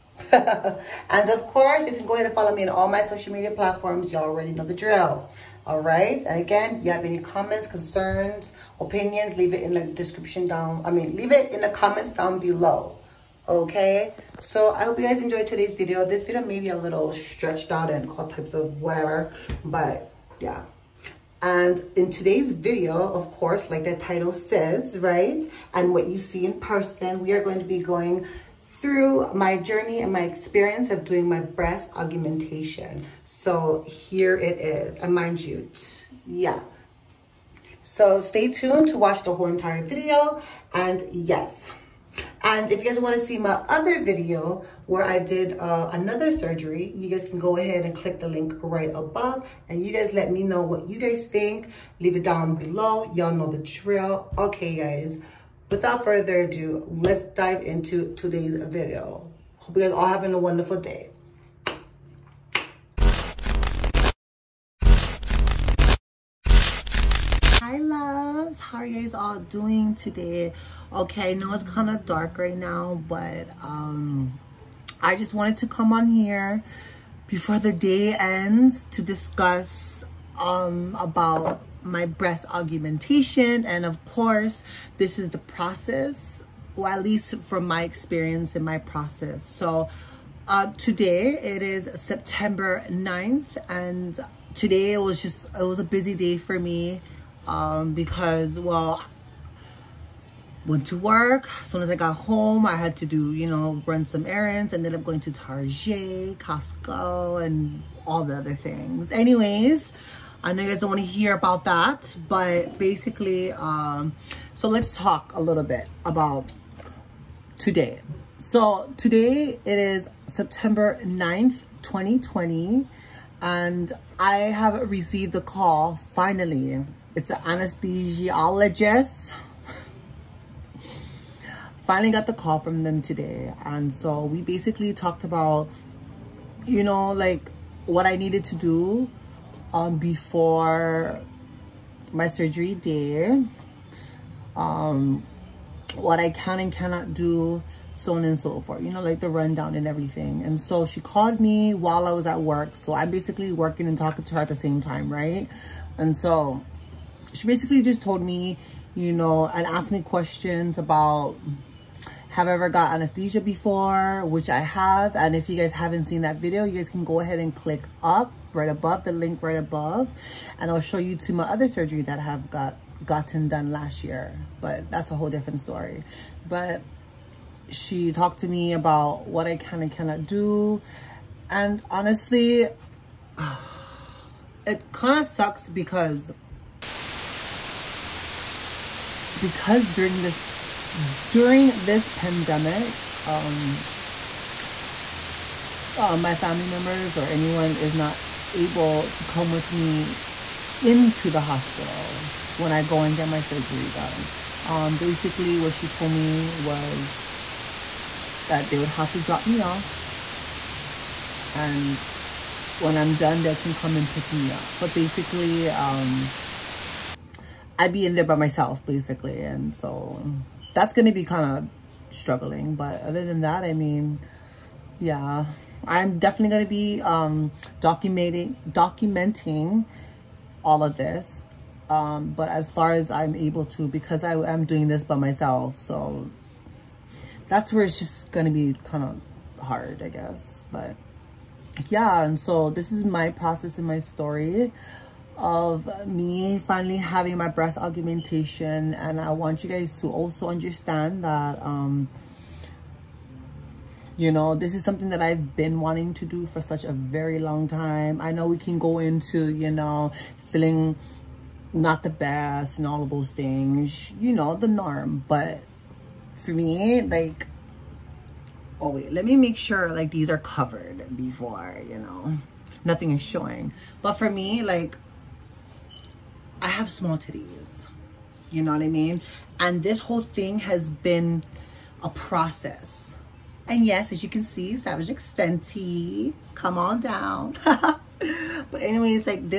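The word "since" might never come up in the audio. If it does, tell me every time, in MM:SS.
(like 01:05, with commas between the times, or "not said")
not said.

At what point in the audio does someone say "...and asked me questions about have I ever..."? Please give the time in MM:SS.
02:39.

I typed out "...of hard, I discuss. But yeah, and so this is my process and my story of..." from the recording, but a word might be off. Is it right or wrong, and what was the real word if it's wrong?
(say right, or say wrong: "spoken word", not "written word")
wrong: "guess", not "discuss".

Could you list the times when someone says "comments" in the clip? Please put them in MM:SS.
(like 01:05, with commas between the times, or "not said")
00:07, 00:11.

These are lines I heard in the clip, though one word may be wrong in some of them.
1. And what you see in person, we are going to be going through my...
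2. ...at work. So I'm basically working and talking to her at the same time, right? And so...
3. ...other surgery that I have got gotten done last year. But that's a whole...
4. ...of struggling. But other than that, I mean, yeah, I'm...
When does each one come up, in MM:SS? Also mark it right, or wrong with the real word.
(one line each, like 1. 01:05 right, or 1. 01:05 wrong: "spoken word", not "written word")
1. 00:25 right
2. 02:32 right
3. 02:51 right
4. 03:42 right.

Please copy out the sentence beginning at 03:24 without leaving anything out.
Um, basically, what she told me was that they would have to drop me off.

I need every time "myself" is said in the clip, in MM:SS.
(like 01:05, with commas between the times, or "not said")
03:38, 03:55.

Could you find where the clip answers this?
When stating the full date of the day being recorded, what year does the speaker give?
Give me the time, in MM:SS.
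02:01.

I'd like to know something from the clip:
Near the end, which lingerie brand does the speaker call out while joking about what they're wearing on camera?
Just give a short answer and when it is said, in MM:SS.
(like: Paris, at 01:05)
Savage X Fenty, at 04:44.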